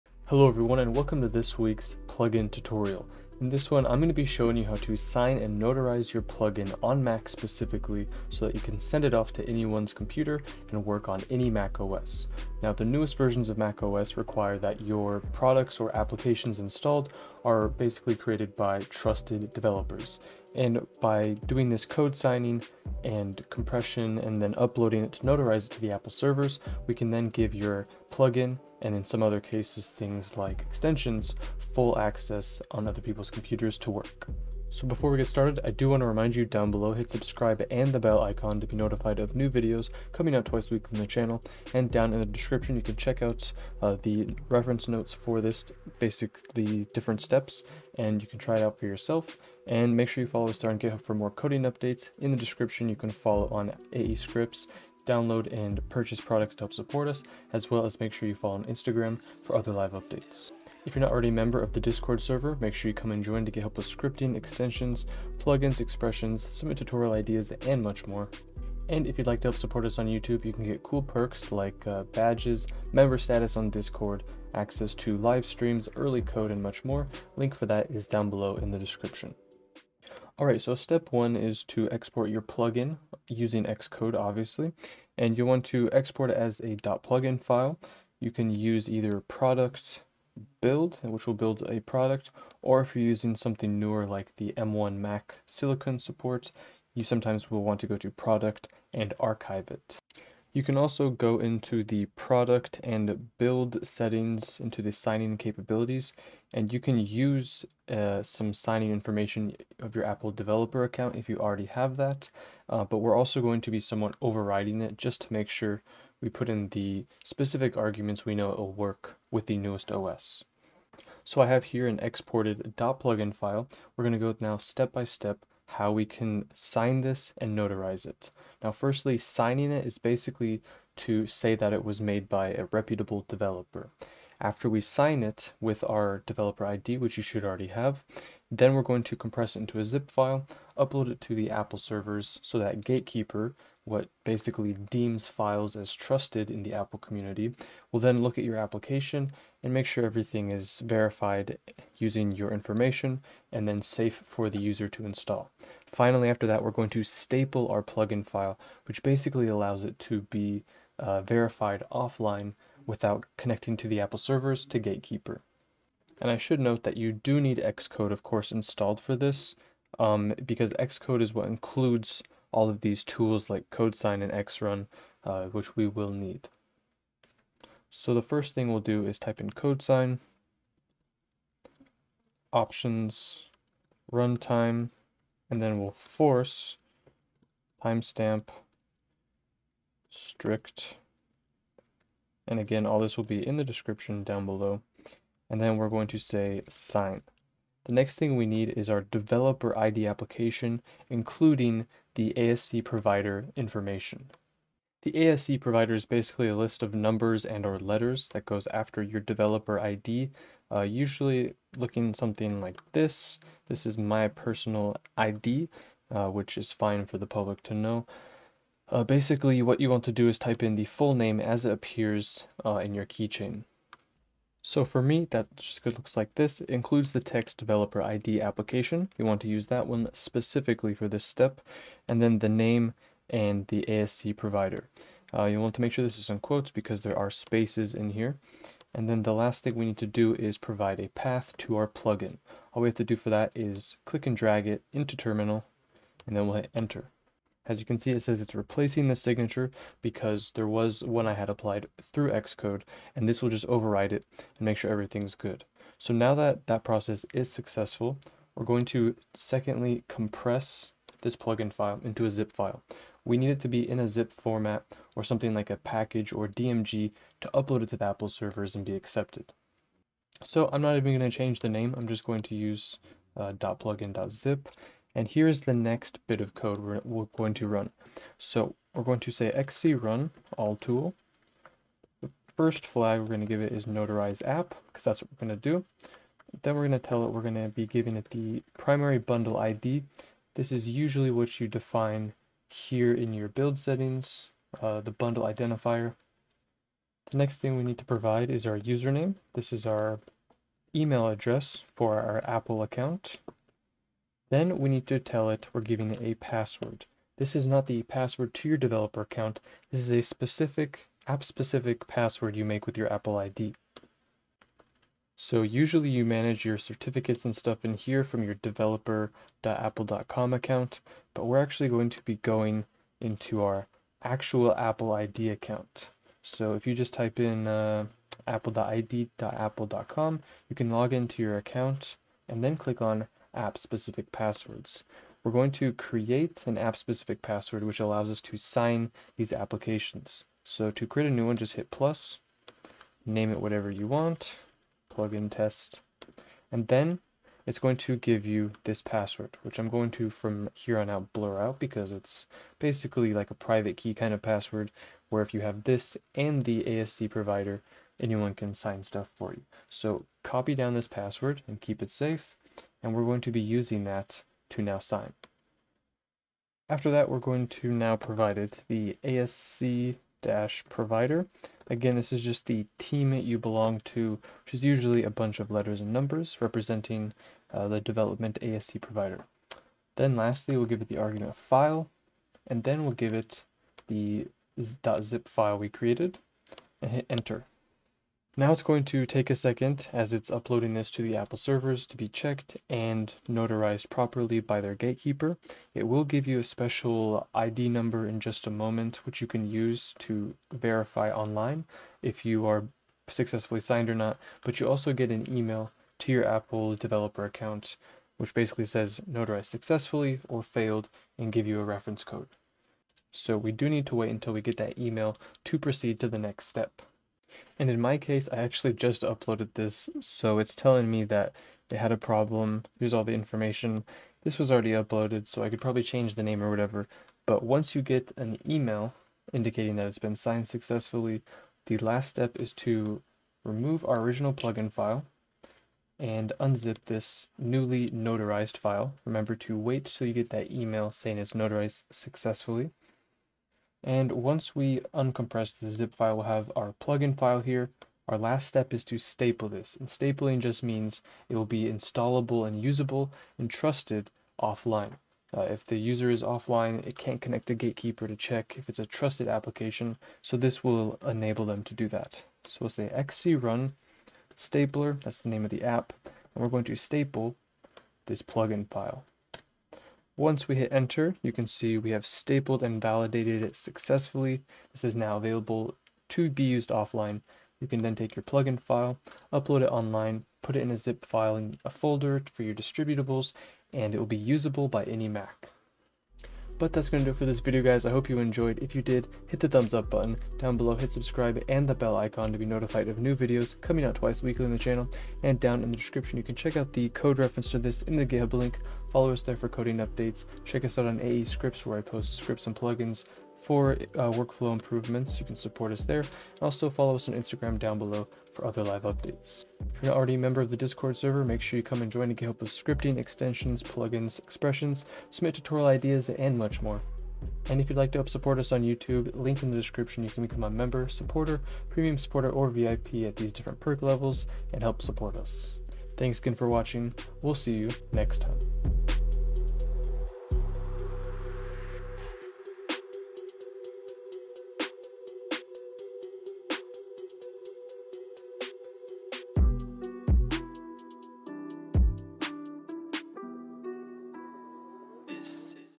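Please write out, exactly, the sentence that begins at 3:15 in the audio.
And then we're going to say sign.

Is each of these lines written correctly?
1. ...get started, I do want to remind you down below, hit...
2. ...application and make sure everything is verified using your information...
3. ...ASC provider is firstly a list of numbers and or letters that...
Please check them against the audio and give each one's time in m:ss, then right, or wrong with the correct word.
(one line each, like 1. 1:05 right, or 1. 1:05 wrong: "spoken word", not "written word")
1. 0:35 right
2. 2:28 right
3. 3:25 wrong: "basically", not "firstly".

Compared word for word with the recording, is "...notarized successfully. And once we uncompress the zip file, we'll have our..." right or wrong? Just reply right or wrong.
right.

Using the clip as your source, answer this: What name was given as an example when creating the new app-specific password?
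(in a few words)
plugin test.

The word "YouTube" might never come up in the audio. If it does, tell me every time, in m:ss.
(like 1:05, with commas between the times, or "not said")
1:10, 8:38.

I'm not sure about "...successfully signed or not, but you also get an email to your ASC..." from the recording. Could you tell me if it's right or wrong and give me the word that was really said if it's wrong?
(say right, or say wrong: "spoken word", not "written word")
wrong: "Apple", not "ASC".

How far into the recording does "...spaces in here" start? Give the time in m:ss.
3:57.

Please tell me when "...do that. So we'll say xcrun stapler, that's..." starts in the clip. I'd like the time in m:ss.
7:41.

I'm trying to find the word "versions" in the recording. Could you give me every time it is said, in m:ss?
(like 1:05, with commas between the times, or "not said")
0:13.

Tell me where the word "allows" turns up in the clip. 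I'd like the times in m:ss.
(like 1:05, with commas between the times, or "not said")
2:39, 5:37.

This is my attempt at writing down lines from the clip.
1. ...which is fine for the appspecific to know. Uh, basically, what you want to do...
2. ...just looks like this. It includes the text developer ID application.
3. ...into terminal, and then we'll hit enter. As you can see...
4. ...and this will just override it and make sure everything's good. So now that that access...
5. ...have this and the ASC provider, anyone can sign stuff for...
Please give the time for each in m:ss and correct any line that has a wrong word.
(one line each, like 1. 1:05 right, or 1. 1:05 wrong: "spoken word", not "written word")
1. 3:36 wrong: "public", not "appspecific"
2. 3:45 right
3. 4:04 right
4. 4:13 wrong: "process", not "access"
5. 5:55 right.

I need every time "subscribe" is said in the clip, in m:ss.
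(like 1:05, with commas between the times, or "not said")
0:37, 8:11.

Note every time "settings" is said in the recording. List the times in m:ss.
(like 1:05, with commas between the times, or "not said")
1:43, 4:53.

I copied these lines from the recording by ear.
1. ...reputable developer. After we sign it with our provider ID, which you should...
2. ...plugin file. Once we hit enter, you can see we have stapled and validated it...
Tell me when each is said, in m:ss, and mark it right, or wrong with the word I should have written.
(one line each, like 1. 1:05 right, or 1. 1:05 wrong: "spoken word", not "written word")
1. 2:12 wrong: "developer", not "provider"
2. 7:48 right.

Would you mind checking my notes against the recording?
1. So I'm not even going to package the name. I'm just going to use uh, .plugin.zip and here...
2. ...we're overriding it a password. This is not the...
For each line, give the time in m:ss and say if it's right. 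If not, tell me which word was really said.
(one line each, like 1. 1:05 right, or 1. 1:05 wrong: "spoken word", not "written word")
1. 4:30 wrong: "change", not "package"
2. 5:05 wrong: "giving", not "overriding".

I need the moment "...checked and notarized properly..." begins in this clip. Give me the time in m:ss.
6:32.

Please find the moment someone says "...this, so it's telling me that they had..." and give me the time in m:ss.
6:59.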